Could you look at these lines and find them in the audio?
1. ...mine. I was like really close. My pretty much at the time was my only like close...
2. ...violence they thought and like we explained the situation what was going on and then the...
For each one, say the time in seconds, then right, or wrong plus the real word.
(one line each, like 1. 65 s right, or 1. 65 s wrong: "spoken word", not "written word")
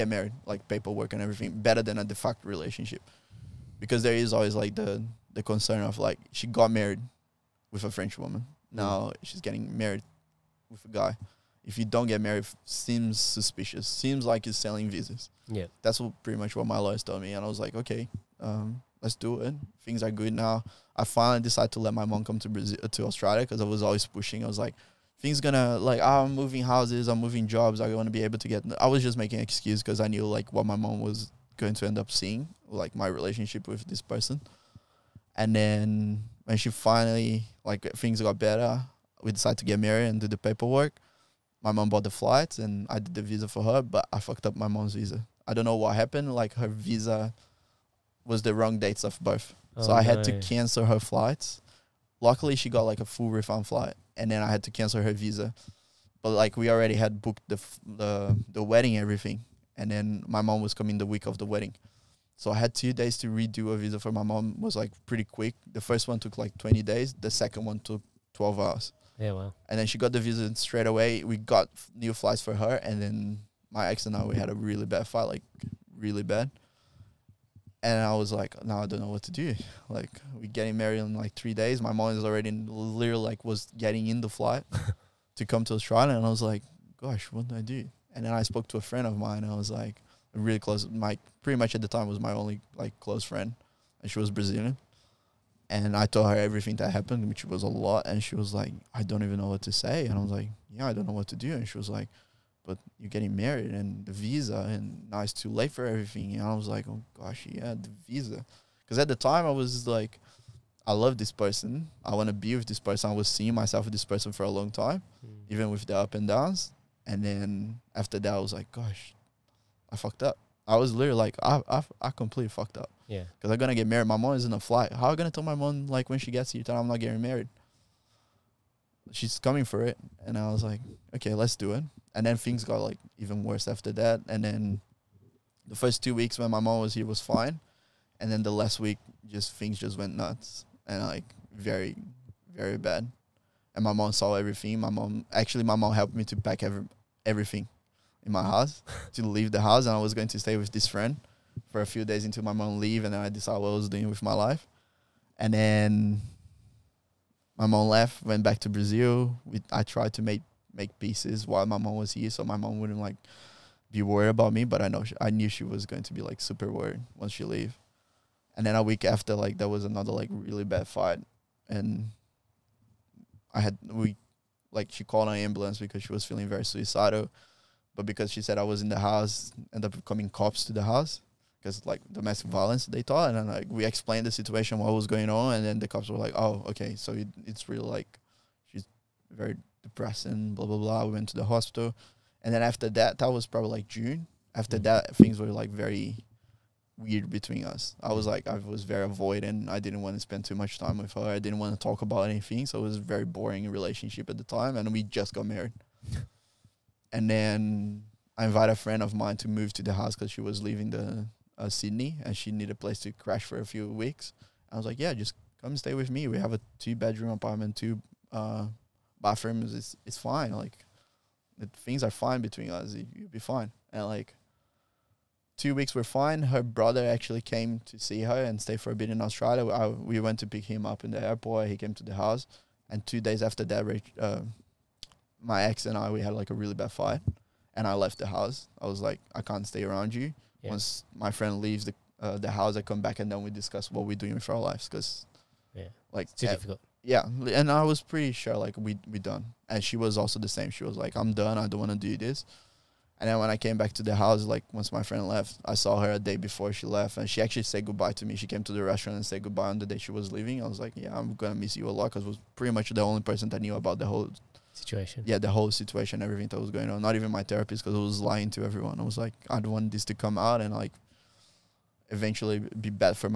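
1. 89 s right
2. 182 s right.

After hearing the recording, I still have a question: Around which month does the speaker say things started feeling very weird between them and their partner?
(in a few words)
June.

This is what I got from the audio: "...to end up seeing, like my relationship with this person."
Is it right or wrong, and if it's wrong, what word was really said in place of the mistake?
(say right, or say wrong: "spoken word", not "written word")
right.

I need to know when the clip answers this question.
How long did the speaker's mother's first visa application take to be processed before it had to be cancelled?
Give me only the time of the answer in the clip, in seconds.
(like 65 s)
66 s.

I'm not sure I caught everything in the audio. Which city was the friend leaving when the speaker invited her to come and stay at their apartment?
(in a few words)
Sydney.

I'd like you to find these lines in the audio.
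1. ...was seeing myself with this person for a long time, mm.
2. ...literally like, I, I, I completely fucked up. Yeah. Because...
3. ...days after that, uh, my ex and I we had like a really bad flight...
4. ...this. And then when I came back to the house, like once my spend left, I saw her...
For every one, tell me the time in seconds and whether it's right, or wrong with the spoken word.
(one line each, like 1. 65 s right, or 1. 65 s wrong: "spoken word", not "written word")
1. 113 s right
2. 120 s right
3. 233 s wrong: "fight", not "flight"
4. 252 s wrong: "friend", not "spend".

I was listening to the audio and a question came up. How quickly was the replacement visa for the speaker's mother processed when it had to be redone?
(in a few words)
12 hours.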